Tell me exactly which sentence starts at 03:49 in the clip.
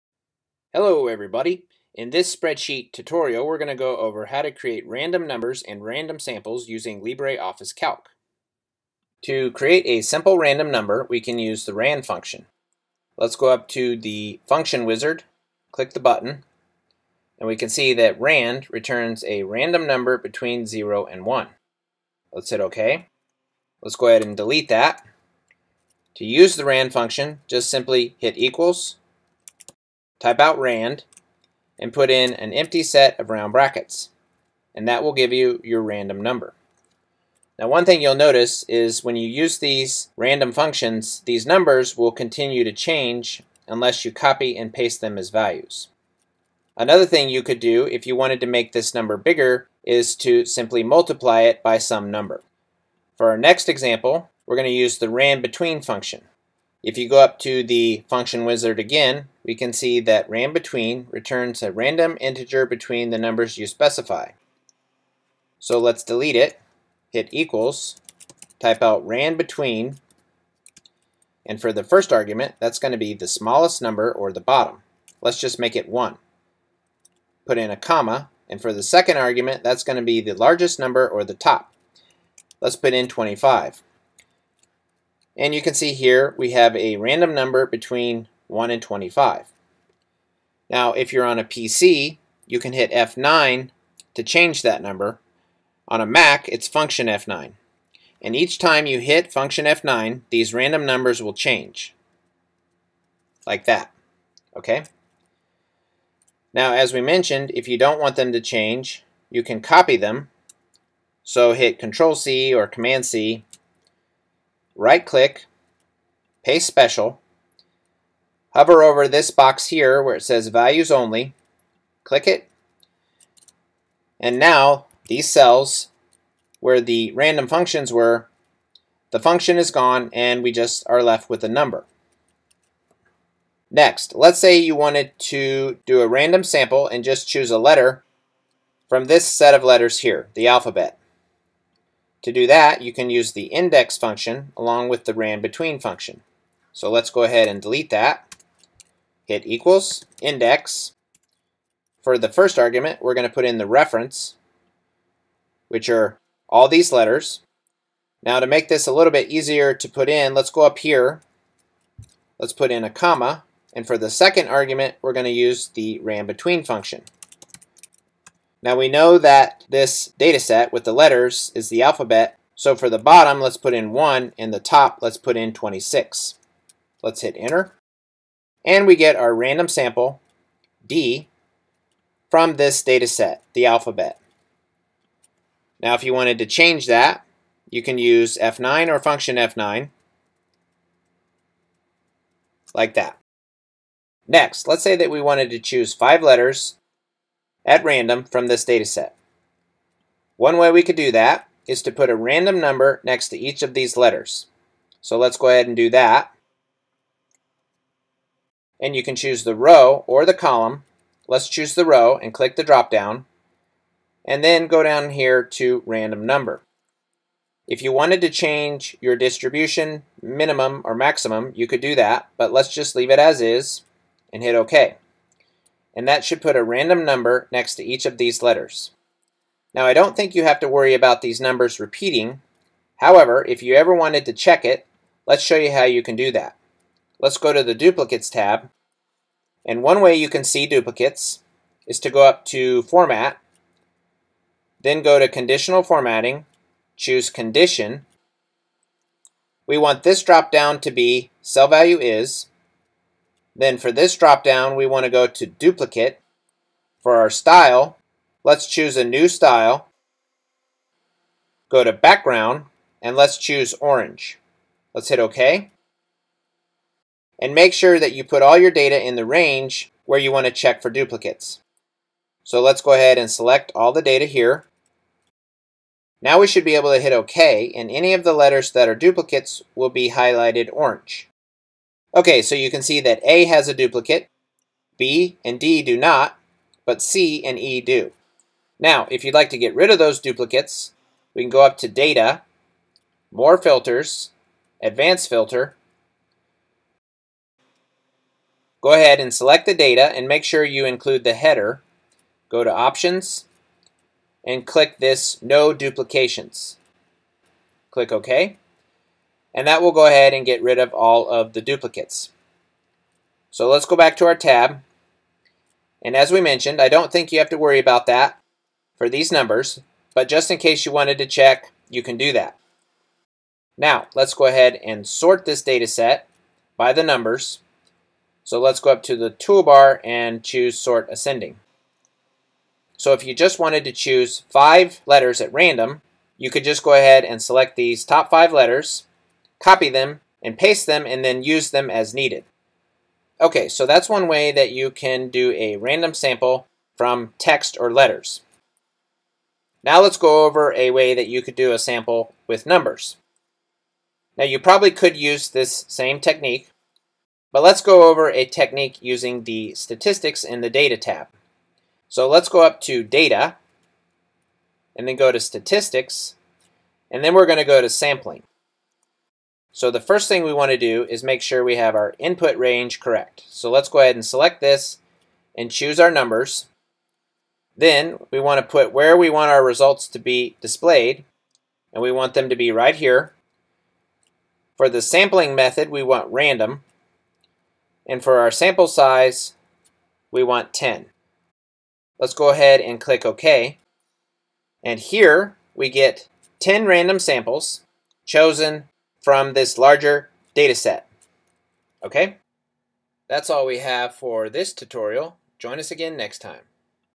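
Now I don't think you have to worry about these numbers repeating.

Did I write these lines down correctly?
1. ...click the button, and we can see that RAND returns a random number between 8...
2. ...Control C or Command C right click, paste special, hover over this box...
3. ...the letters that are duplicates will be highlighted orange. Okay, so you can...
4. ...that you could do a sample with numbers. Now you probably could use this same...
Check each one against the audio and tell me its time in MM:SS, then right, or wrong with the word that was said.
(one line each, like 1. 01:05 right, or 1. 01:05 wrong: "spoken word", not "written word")
1. 00:15 wrong: "0", not "8"
2. 01:51 right
3. 04:38 right
4. 05:51 right.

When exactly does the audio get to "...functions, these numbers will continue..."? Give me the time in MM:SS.
00:40.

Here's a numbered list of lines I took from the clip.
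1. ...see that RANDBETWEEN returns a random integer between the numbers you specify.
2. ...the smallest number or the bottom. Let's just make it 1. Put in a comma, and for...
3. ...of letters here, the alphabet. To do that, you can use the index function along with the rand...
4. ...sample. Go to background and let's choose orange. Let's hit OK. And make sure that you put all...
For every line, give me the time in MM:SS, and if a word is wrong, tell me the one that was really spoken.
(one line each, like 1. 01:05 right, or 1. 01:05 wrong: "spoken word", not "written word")
1. 00:59 right
2. 01:13 right
3. 02:19 right
4. 04:19 wrong: "style", not "sample".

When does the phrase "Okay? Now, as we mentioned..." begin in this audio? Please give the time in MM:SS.
01:44.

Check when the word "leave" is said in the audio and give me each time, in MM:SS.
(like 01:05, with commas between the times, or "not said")
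03:42.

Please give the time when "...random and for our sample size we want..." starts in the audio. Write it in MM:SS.
06:26.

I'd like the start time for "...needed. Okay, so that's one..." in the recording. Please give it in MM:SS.
05:42.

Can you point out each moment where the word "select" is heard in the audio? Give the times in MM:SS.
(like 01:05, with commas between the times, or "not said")
04:33, 04:59, 05:37, 06:14.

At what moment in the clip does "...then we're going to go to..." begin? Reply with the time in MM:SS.
06:07.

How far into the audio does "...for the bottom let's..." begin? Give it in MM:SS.
02:52.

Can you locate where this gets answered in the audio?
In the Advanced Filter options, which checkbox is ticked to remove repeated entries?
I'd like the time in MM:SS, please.
05:05.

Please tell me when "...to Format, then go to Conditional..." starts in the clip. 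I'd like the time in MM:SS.
04:02.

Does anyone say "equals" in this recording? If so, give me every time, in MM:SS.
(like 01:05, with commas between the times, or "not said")
00:28, 01:07, 02:29.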